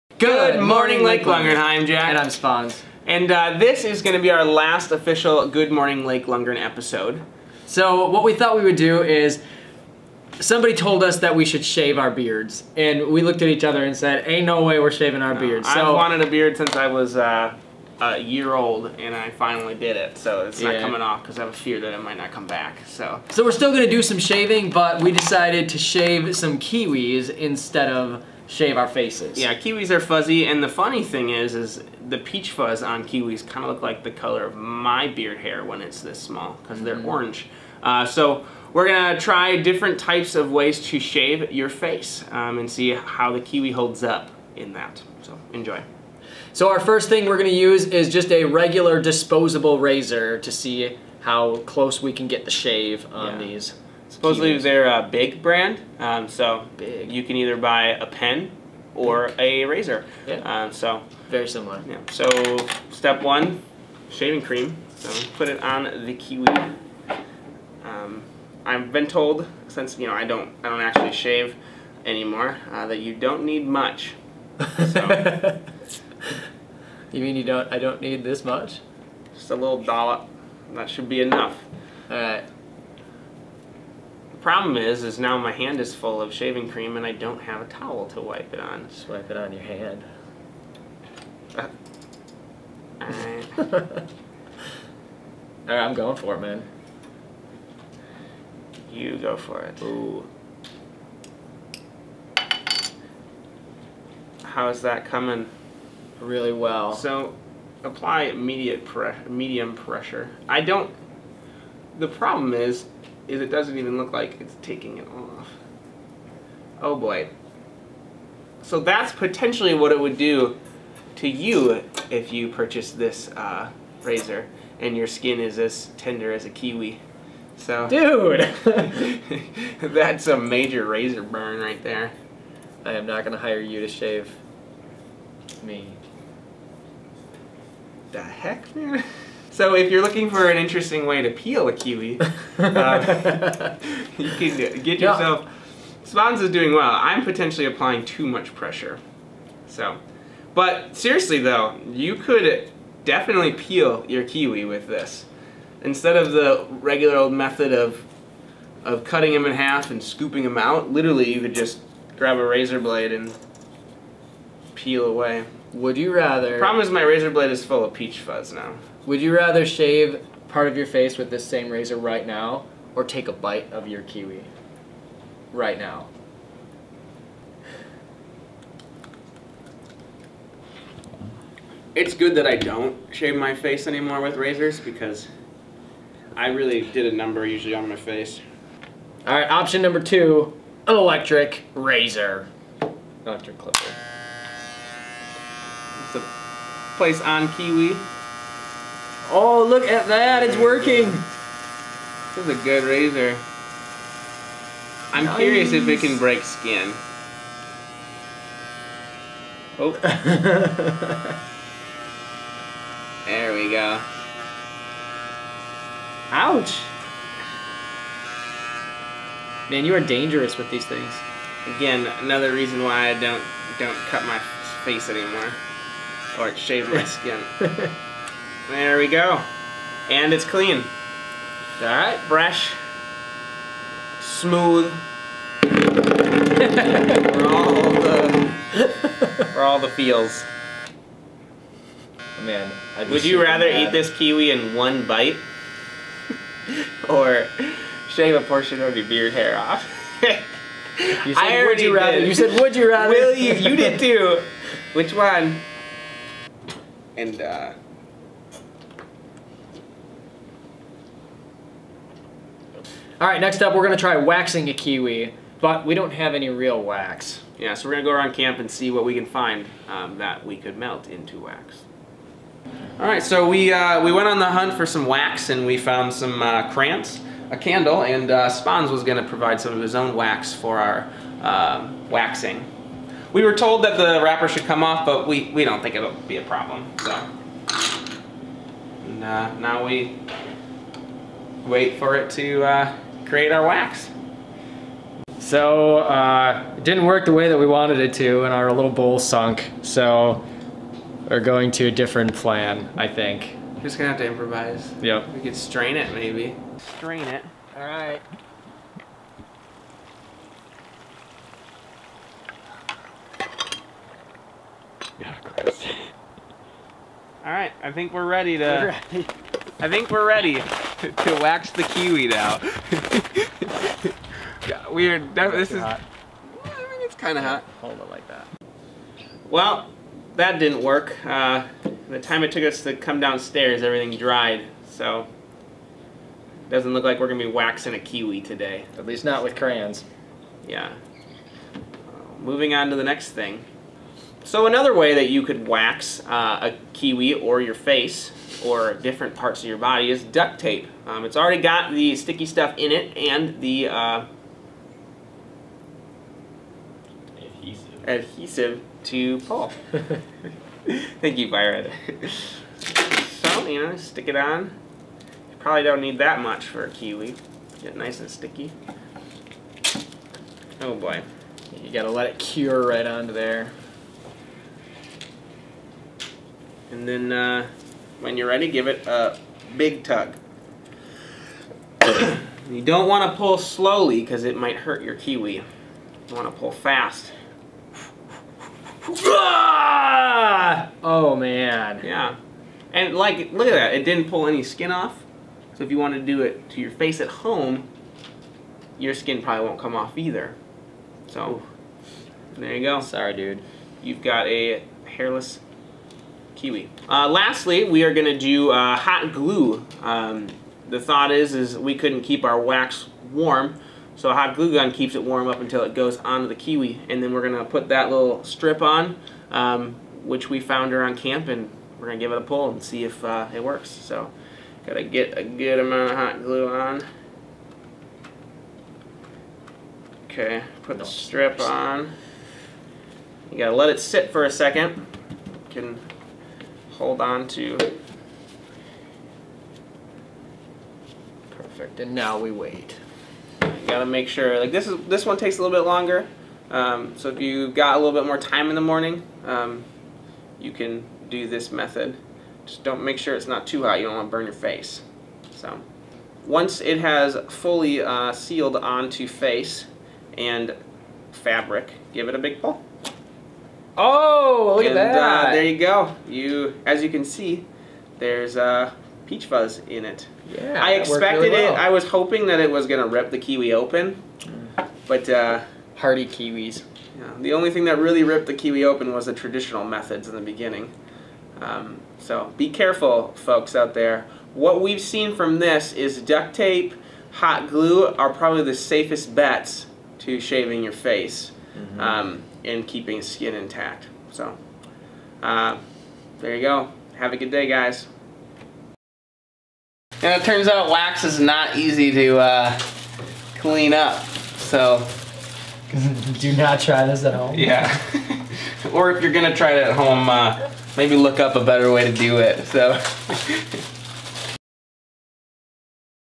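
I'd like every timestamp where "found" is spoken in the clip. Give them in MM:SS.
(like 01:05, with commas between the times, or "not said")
04:35, 07:00.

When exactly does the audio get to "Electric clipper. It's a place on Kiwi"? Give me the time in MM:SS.
03:13.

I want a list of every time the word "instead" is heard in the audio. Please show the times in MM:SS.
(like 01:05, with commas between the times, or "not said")
00:27, 02:35.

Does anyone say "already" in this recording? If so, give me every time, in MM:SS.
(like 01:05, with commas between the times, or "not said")
04:11, 05:51.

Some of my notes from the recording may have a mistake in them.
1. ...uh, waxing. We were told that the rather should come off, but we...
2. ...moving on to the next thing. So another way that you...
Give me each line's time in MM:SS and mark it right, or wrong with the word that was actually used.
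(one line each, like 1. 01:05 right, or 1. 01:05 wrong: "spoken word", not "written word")
1. 04:41 wrong: "wrapper", not "rather"
2. 05:42 right.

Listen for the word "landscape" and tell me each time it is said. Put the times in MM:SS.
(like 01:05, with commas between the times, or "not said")
not said.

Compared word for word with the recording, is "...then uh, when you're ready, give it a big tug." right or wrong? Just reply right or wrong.
right.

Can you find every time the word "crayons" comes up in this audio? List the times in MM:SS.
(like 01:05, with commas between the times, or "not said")
04:36, 05:39.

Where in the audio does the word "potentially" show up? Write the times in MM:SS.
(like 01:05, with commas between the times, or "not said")
01:59, 02:27.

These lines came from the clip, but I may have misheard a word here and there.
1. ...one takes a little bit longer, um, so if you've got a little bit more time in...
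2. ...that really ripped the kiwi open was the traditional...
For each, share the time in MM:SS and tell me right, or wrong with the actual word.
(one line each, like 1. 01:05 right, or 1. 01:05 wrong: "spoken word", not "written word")
1. 07:25 right
2. 07:57 right.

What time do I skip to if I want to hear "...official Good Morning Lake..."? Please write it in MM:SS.
00:04.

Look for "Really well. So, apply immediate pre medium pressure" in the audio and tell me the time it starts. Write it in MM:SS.
01:46.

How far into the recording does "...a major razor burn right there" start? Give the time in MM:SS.
02:10.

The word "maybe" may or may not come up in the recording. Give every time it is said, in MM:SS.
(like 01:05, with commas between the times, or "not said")
05:06, 08:30.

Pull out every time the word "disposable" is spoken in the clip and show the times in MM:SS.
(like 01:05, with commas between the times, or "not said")
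00:49.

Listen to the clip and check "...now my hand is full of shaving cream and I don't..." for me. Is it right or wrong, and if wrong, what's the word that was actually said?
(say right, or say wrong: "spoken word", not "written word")
right.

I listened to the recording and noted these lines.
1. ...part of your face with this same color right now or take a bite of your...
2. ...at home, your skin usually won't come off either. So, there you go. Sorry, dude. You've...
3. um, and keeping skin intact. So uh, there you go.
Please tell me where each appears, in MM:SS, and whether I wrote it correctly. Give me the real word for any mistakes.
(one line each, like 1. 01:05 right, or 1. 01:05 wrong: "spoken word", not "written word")
1. 02:50 wrong: "razor", not "color"
2. 06:37 wrong: "probably", not "usually"
3. 08:12 right.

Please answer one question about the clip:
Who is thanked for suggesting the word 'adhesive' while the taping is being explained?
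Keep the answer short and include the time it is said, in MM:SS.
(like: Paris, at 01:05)
Byron, at 06:01.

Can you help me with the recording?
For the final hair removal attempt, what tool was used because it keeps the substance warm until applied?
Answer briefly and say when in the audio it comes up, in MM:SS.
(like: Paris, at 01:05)
Hot glue gun, at 06:54.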